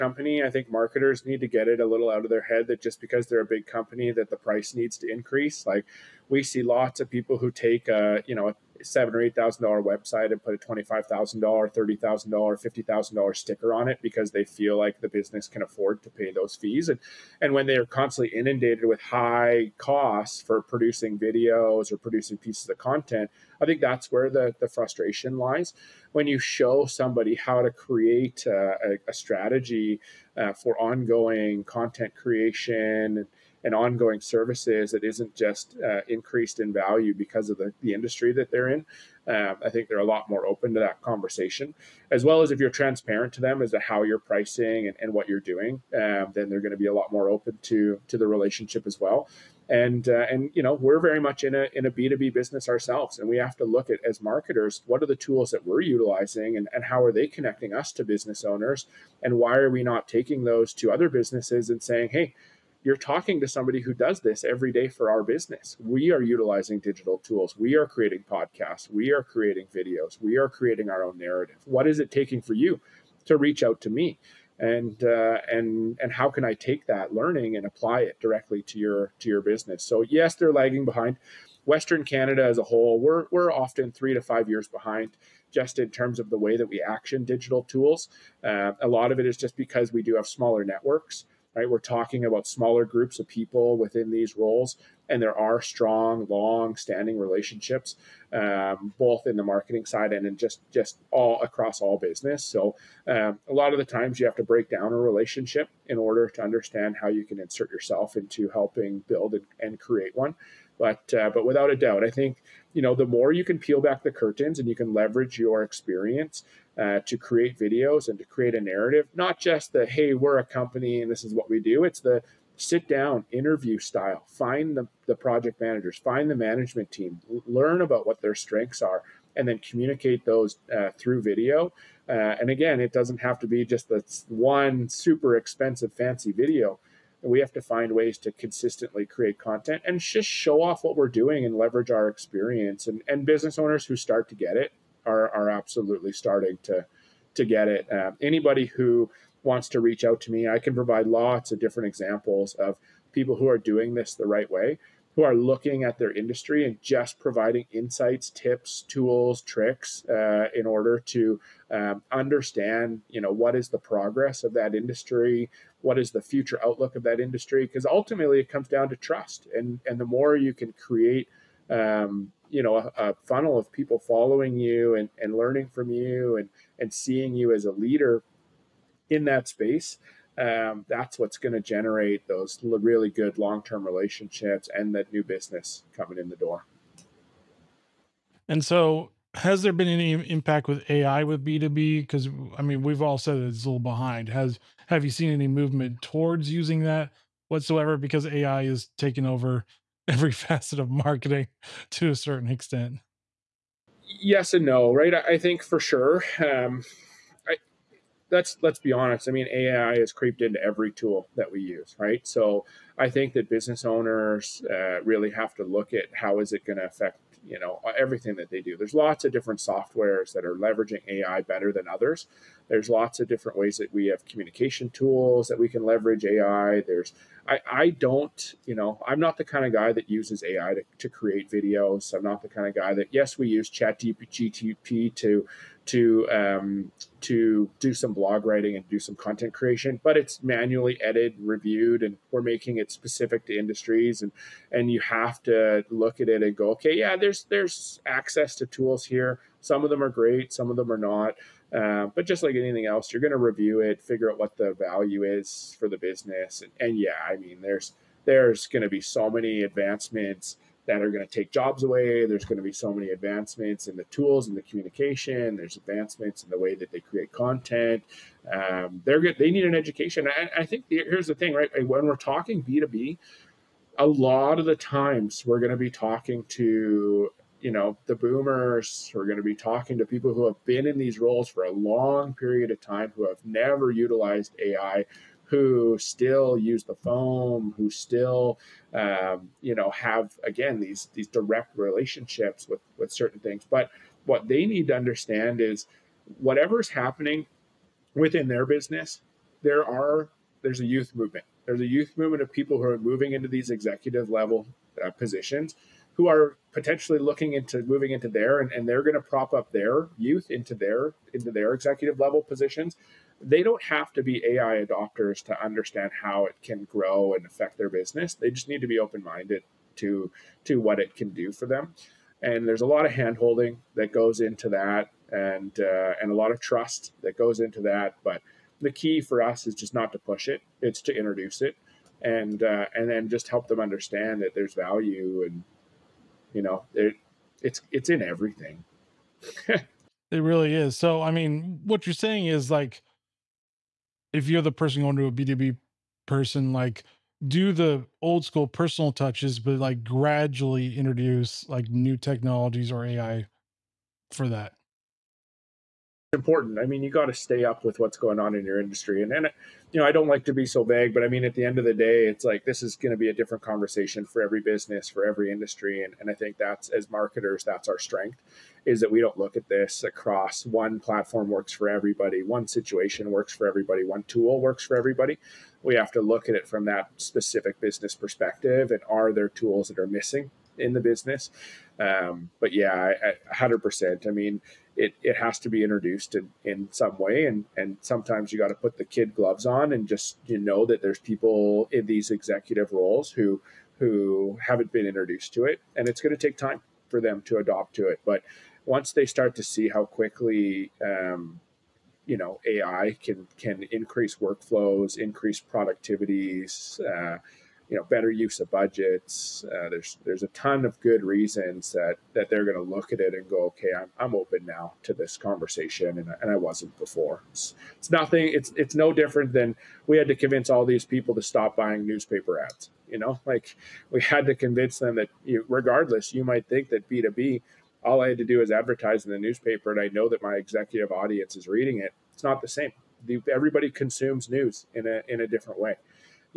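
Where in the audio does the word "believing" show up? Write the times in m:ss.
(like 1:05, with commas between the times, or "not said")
not said.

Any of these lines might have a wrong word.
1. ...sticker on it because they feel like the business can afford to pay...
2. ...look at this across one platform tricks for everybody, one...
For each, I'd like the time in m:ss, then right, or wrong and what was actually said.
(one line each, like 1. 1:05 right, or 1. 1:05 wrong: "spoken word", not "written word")
1. 0:13 right
2. 6:09 wrong: "works", not "tricks".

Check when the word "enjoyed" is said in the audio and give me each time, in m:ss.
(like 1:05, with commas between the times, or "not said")
not said.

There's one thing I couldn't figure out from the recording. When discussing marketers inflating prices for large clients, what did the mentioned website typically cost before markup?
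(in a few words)
7 or 8 thousand dollars.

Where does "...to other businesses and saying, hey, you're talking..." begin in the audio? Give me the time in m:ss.
1:00.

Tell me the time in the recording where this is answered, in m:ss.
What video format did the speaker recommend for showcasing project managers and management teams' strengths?
2:02.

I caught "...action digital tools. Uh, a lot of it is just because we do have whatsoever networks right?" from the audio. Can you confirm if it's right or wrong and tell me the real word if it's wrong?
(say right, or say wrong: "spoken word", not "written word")
wrong: "smaller", not "whatsoever".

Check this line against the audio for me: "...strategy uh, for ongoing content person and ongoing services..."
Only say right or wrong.
wrong.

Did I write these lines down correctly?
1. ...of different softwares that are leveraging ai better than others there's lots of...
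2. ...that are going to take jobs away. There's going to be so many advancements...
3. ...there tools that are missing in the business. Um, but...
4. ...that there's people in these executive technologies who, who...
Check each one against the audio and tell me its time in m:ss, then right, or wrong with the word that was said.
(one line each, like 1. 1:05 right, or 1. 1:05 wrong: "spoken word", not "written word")
1. 3:39 right
2. 4:20 right
3. 6:19 right
4. 6:30 wrong: "roles", not "technologies".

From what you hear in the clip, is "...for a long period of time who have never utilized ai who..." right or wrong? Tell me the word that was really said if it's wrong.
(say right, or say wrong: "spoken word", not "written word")
right.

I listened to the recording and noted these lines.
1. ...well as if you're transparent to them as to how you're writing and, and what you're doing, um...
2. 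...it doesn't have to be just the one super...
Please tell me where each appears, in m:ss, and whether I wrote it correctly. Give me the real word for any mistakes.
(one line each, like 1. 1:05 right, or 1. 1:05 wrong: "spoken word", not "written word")
1. 0:42 wrong: "pricing", not "writing"
2. 2:12 right.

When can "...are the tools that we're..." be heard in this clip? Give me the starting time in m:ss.
0:55.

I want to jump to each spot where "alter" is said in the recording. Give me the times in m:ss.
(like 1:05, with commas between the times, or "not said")
not said.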